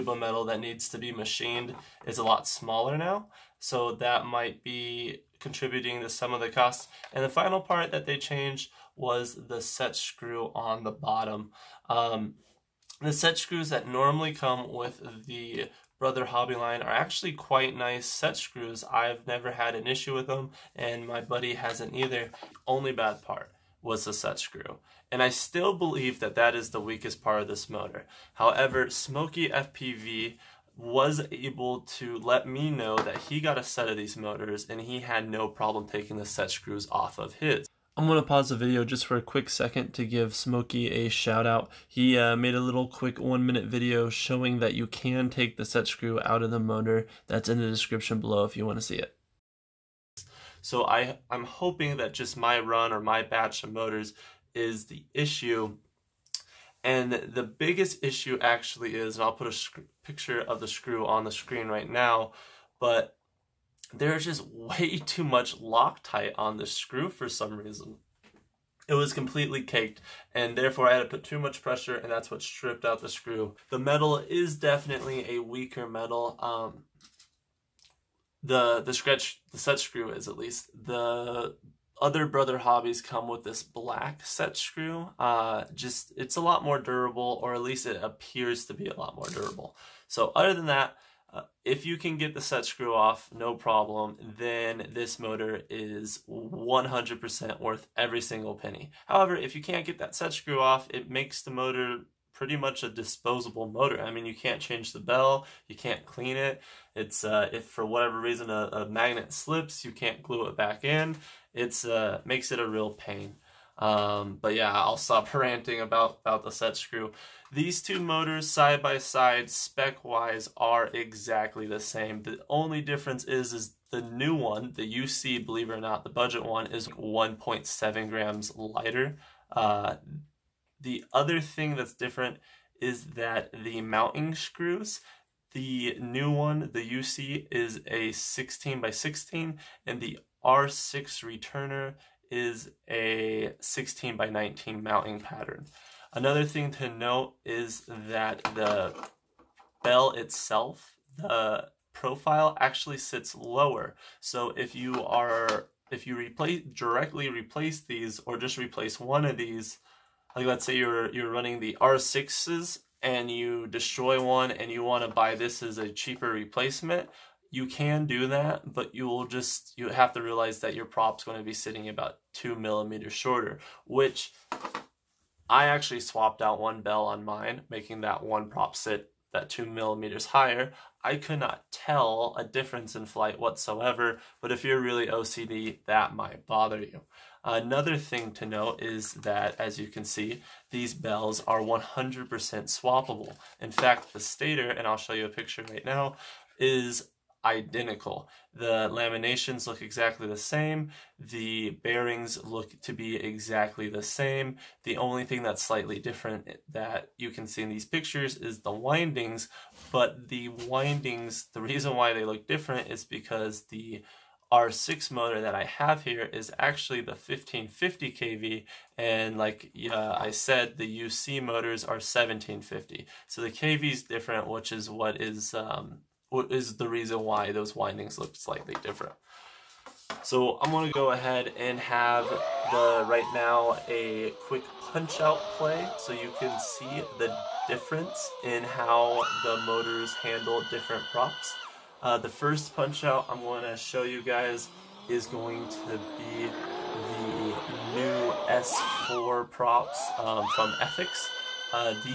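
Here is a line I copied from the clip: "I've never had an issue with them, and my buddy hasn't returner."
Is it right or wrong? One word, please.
wrong.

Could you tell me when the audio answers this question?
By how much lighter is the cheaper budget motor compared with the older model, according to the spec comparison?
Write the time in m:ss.
2:06.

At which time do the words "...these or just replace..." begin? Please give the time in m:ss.
2:37.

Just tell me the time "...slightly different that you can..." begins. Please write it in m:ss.
3:25.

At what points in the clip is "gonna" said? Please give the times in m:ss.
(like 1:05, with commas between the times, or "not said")
3:50, 4:03.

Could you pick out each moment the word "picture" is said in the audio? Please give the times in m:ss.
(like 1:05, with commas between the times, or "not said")
1:00, 3:15, 3:27.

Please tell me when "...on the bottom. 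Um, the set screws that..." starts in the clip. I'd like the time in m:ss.
0:10.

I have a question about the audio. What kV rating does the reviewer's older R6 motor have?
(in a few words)
1550 kV.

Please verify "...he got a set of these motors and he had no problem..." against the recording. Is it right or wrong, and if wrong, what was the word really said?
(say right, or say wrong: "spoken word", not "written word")
right.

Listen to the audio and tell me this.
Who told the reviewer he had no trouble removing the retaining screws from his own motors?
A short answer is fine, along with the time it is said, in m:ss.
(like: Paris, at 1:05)
Smoky FPV, at 0:28.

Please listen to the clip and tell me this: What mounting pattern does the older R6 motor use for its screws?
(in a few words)
16 by 19.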